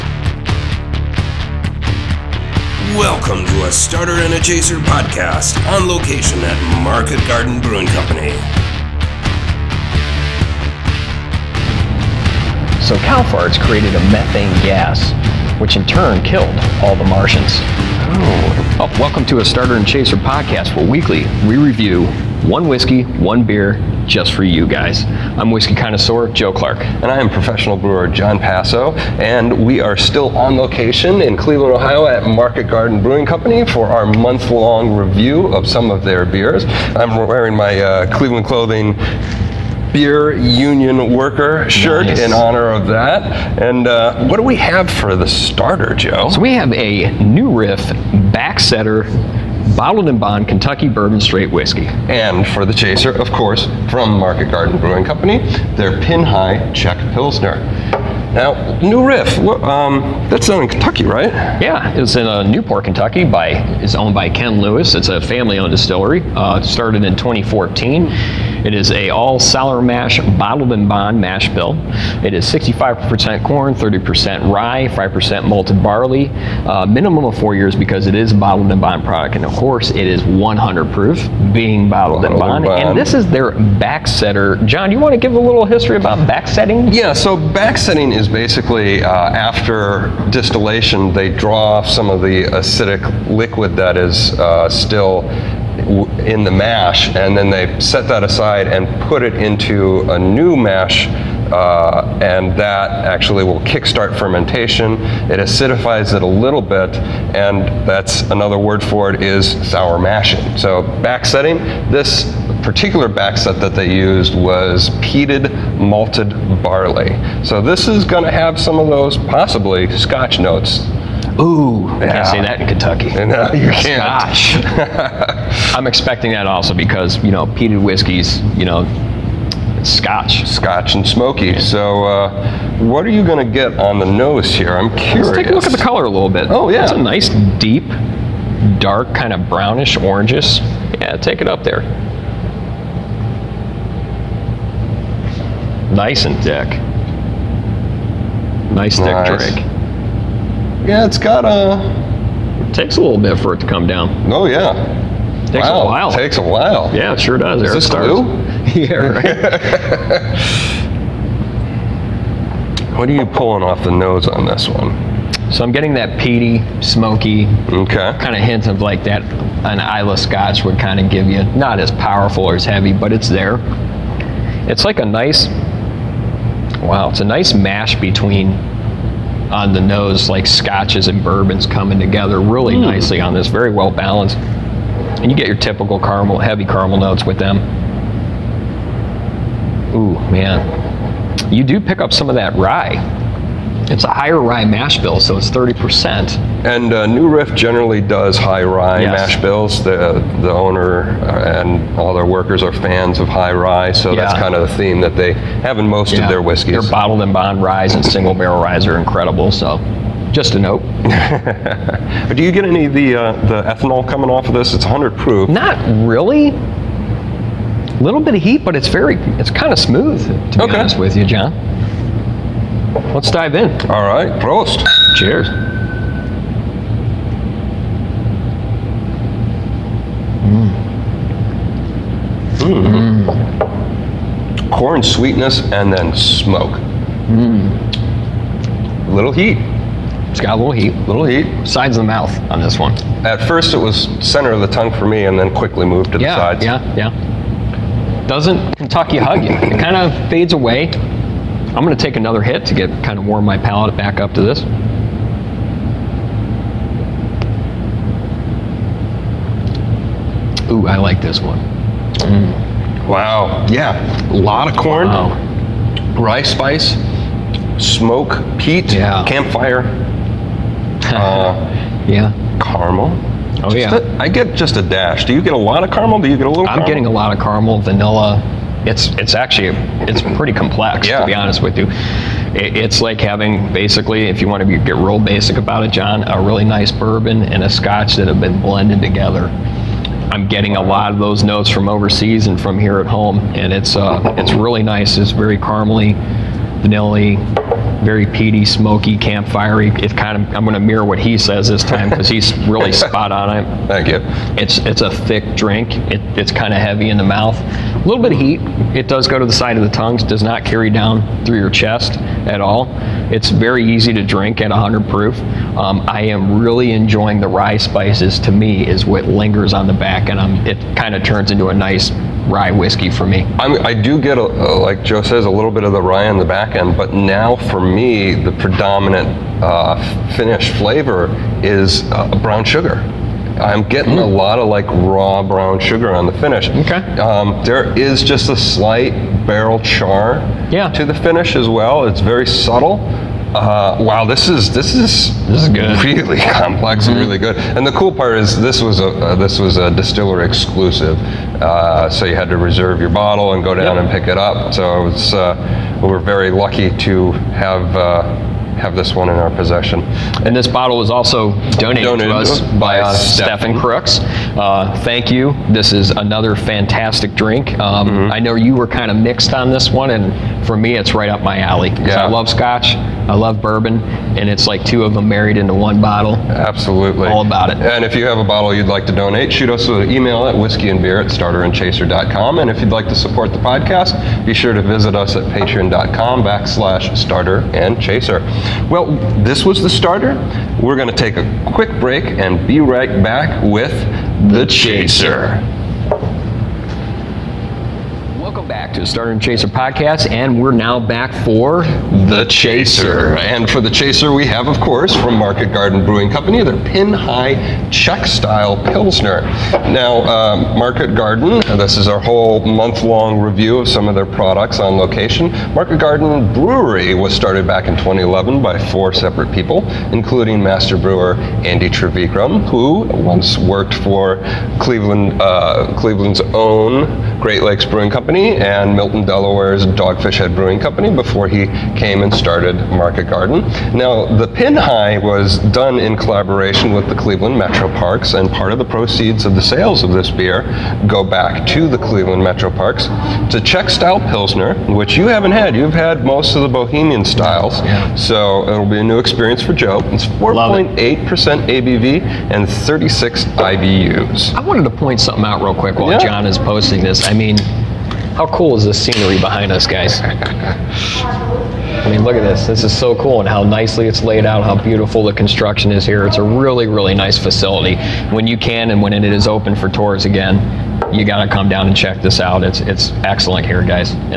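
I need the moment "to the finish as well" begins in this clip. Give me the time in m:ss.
5:40.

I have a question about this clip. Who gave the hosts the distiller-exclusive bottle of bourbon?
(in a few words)
Stephen Crooks.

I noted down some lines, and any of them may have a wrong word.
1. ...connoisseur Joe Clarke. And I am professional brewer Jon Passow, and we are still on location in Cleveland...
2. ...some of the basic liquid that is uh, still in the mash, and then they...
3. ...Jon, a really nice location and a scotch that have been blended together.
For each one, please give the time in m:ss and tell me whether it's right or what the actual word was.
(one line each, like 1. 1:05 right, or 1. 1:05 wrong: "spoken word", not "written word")
1. 0:25 right
2. 1:31 wrong: "acidic", not "basic"
3. 4:45 wrong: "bourbon", not "location".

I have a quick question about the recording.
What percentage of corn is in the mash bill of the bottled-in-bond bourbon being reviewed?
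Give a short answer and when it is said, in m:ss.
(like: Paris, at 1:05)
65%, at 1:12.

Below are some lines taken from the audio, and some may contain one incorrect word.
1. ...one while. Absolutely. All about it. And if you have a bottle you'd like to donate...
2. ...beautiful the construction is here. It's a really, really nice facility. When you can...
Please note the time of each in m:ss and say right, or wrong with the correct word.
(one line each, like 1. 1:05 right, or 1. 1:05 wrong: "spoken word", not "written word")
1. 6:15 wrong: "bottle", not "while"
2. 7:44 right.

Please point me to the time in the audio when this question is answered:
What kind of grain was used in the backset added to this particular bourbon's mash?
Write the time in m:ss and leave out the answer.
1:55.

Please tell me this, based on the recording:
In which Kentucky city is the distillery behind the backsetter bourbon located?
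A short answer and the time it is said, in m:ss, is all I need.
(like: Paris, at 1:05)
Newport, at 1:02.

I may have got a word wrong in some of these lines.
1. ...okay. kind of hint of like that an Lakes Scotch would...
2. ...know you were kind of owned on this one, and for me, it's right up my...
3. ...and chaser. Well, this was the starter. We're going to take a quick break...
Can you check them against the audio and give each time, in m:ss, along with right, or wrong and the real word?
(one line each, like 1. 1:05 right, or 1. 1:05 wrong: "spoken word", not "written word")
1. 2:47 wrong: "Islay", not "Lakes"
2. 6:08 wrong: "mixed", not "owned"
3. 6:27 right.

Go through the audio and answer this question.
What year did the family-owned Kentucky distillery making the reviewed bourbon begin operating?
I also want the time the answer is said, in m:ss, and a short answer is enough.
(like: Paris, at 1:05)
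2014, at 1:07.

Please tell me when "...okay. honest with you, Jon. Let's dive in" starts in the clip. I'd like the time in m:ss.
3:40.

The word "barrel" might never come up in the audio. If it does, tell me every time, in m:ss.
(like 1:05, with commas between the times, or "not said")
3:28, 5:39.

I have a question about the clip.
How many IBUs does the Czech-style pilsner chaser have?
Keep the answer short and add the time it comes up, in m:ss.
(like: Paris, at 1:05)
36, at 7:32.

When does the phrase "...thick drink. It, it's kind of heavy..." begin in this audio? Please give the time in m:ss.
5:05.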